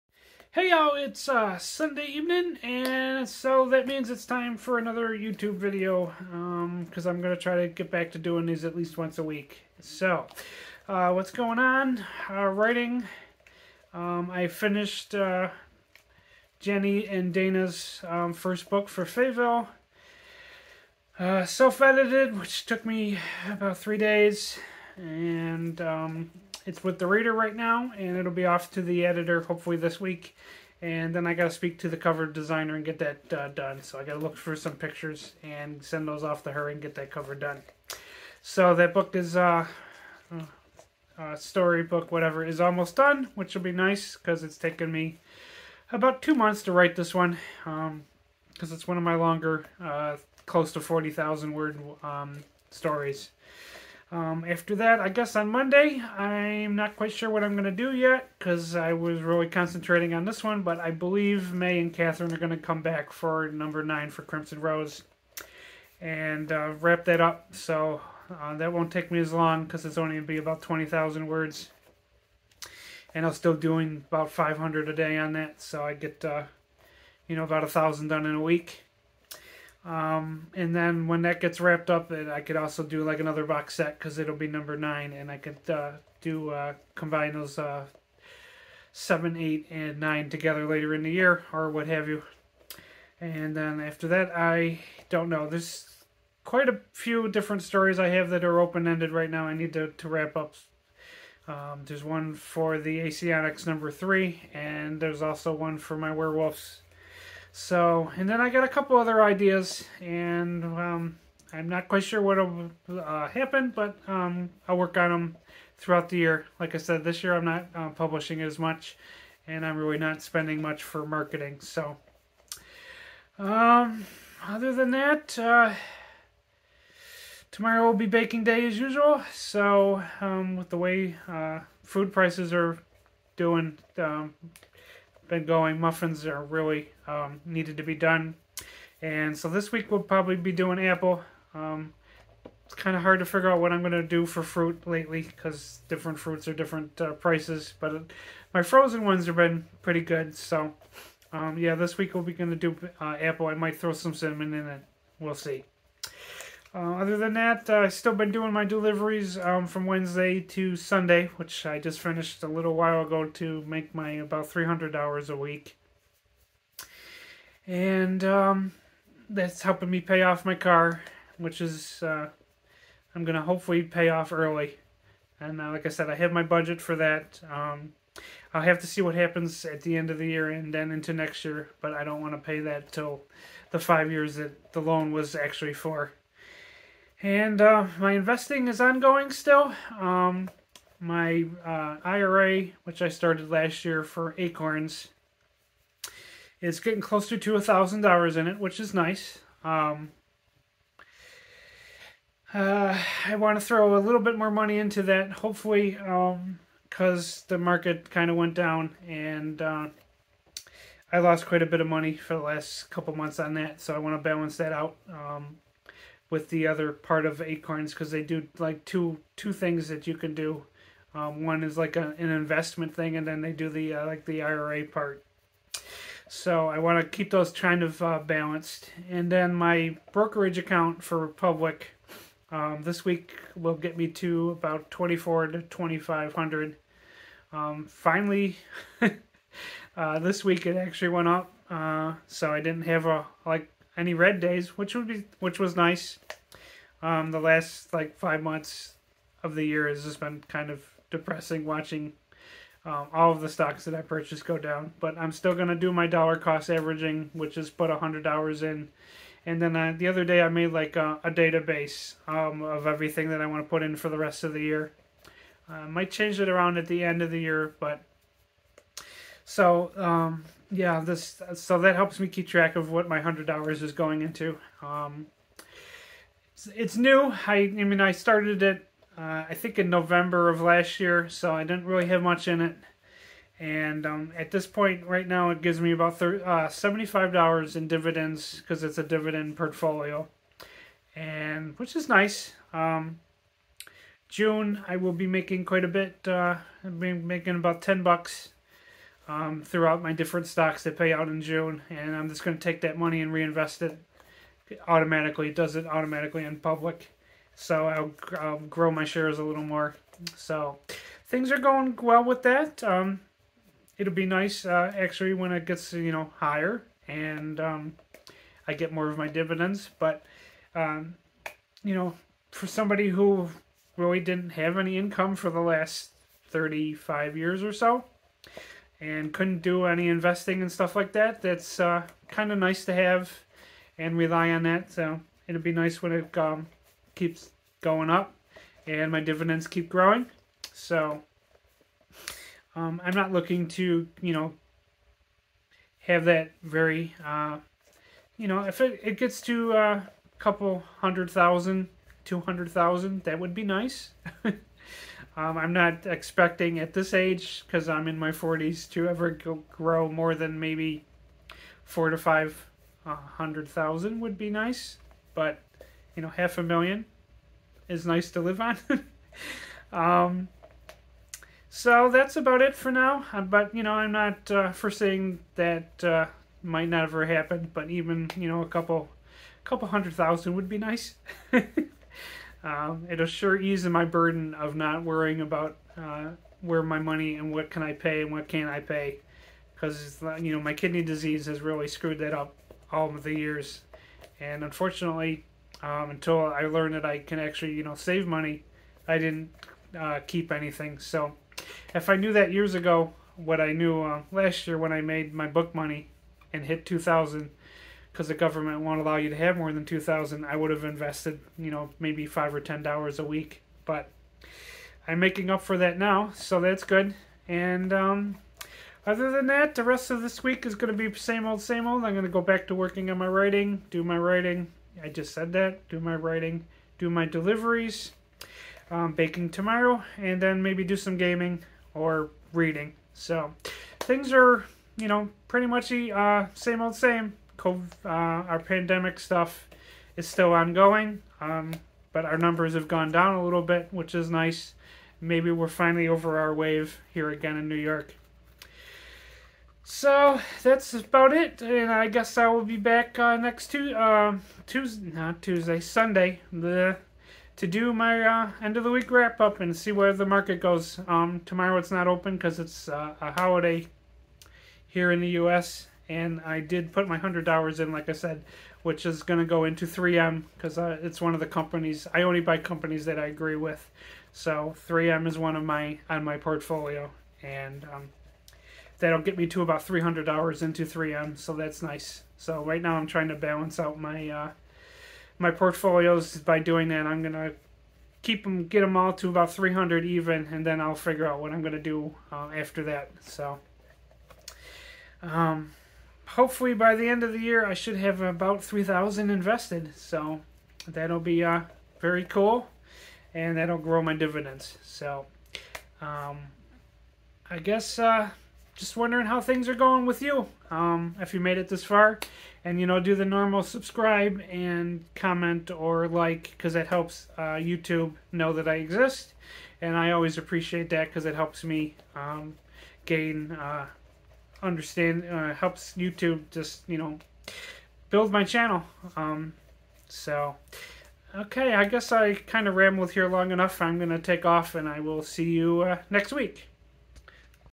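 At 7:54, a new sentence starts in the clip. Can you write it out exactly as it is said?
So 3M is one of my on my portfolio, and um, that'll get me to about three hundred dollars into 3M.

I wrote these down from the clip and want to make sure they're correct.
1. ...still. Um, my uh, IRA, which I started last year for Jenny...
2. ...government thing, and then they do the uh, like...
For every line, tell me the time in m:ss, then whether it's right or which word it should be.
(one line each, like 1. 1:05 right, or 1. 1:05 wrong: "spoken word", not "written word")
1. 3:09 wrong: "Acorns", not "Jenny"
2. 3:42 wrong: "investment", not "government".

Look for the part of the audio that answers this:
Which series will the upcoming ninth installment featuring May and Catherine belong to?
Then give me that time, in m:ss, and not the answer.
1:04.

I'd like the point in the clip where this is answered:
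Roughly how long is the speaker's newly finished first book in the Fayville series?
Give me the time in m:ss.
0:50.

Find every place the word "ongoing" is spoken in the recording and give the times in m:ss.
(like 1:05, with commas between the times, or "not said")
3:08, 7:20.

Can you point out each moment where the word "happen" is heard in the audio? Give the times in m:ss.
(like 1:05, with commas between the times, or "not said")
1:53, 2:59, 6:17.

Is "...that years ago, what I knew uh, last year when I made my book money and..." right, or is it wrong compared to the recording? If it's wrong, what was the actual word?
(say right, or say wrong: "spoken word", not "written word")
right.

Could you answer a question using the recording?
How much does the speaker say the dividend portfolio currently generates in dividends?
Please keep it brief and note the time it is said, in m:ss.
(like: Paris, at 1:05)
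$75, at 4:46.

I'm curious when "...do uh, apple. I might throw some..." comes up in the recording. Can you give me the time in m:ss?
2:32.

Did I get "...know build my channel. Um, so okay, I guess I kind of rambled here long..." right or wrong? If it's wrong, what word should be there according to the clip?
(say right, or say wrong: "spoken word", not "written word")
right.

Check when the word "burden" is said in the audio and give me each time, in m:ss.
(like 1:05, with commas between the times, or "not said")
6:24.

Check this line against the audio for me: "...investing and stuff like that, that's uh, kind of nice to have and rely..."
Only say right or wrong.
right.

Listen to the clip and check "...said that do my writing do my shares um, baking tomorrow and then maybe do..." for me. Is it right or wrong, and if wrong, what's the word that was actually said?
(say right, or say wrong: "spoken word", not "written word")
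wrong: "deliveries", not "shares".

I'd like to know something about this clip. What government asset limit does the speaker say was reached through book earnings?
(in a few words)
2000.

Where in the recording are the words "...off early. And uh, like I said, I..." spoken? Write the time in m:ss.
2:54.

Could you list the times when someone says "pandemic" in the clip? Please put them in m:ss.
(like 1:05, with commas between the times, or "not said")
7:18.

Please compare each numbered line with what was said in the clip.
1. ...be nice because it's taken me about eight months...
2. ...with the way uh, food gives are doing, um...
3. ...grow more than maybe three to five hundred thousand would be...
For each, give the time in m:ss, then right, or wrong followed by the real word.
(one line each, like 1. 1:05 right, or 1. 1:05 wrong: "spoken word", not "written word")
1. 0:43 wrong: "two", not "eight"
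2. 2:10 wrong: "prices", not "gives"
3. 5:59 wrong: "four", not "three".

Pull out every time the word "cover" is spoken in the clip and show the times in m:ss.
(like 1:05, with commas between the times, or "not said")
0:31, 0:37.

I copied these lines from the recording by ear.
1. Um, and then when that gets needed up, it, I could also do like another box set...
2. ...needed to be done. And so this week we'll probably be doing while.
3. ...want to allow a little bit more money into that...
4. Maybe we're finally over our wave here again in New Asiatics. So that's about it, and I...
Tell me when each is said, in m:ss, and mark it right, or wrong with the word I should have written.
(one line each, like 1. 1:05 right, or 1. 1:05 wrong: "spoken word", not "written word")
1. 1:19 wrong: "wrapped", not "needed"
2. 2:17 wrong: "apple", not "while"
3. 3:23 wrong: "throw", not "allow"
4. 7:25 wrong: "York", not "Asiatics".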